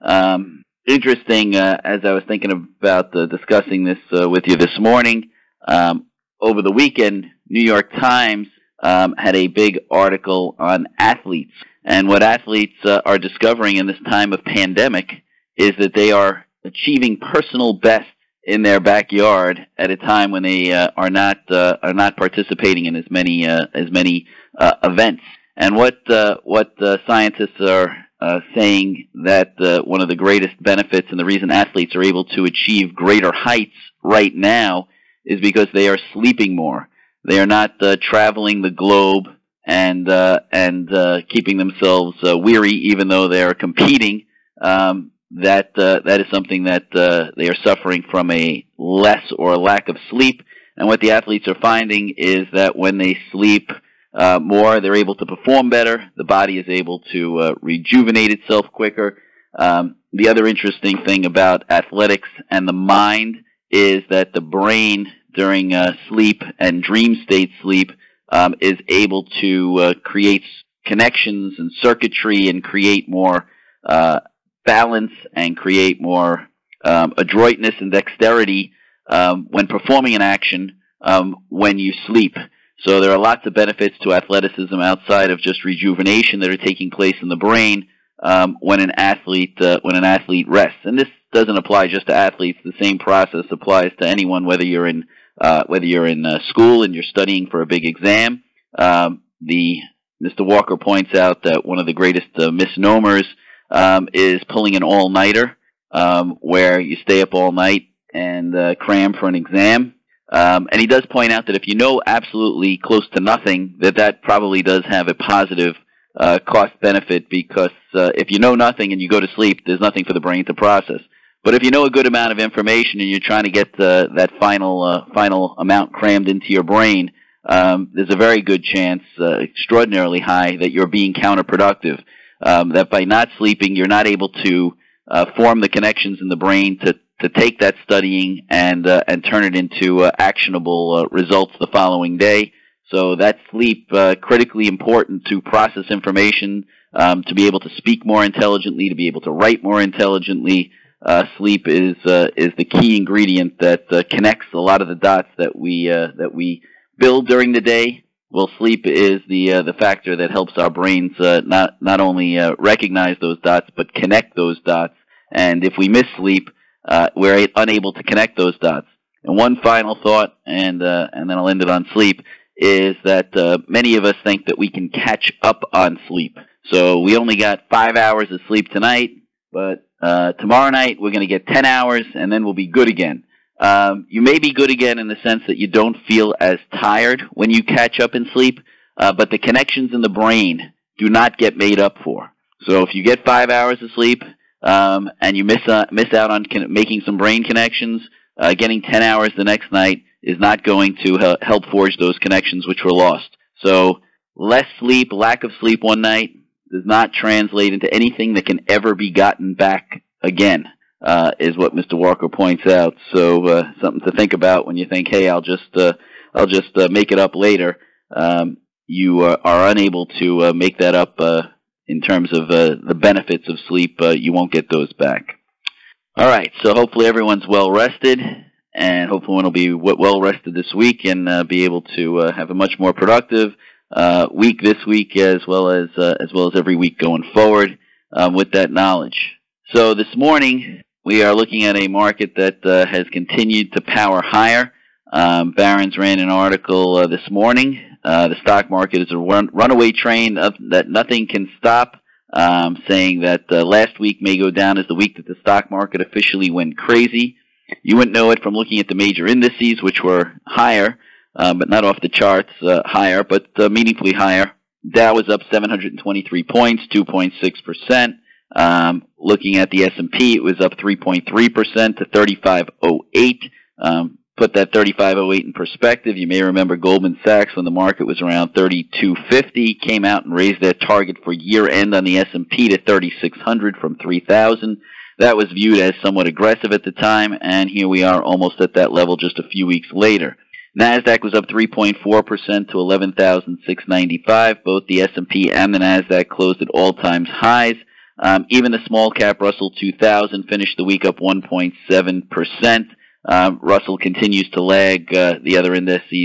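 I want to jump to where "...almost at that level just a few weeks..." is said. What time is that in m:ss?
4:48.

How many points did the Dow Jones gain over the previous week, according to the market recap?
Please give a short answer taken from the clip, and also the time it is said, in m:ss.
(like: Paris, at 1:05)
723, at 4:25.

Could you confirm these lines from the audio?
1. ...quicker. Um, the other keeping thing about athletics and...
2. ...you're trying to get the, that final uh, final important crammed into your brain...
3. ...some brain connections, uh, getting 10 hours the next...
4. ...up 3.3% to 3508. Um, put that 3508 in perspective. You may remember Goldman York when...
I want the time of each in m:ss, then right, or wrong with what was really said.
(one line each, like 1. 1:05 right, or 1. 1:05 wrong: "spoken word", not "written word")
1. 0:58 wrong: "interesting", not "keeping"
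2. 2:03 wrong: "amount", not "important"
3. 3:17 right
4. 4:30 wrong: "Sachs", not "York".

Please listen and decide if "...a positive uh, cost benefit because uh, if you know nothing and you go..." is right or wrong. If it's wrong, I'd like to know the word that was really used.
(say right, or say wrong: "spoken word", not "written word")
right.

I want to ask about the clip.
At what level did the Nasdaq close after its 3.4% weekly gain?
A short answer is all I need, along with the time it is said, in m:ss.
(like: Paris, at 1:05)
11,695, at 4:52.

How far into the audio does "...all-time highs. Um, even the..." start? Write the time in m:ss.
4:56.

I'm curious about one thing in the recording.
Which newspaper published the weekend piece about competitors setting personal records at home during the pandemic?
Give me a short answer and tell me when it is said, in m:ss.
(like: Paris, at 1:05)
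New York Times, at 0:07.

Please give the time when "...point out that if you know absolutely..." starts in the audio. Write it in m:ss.
1:51.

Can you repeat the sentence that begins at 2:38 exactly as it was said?
Well, sleep is the uh, the factor that helps our brains uh, not not only recognize those dots but connect those dots.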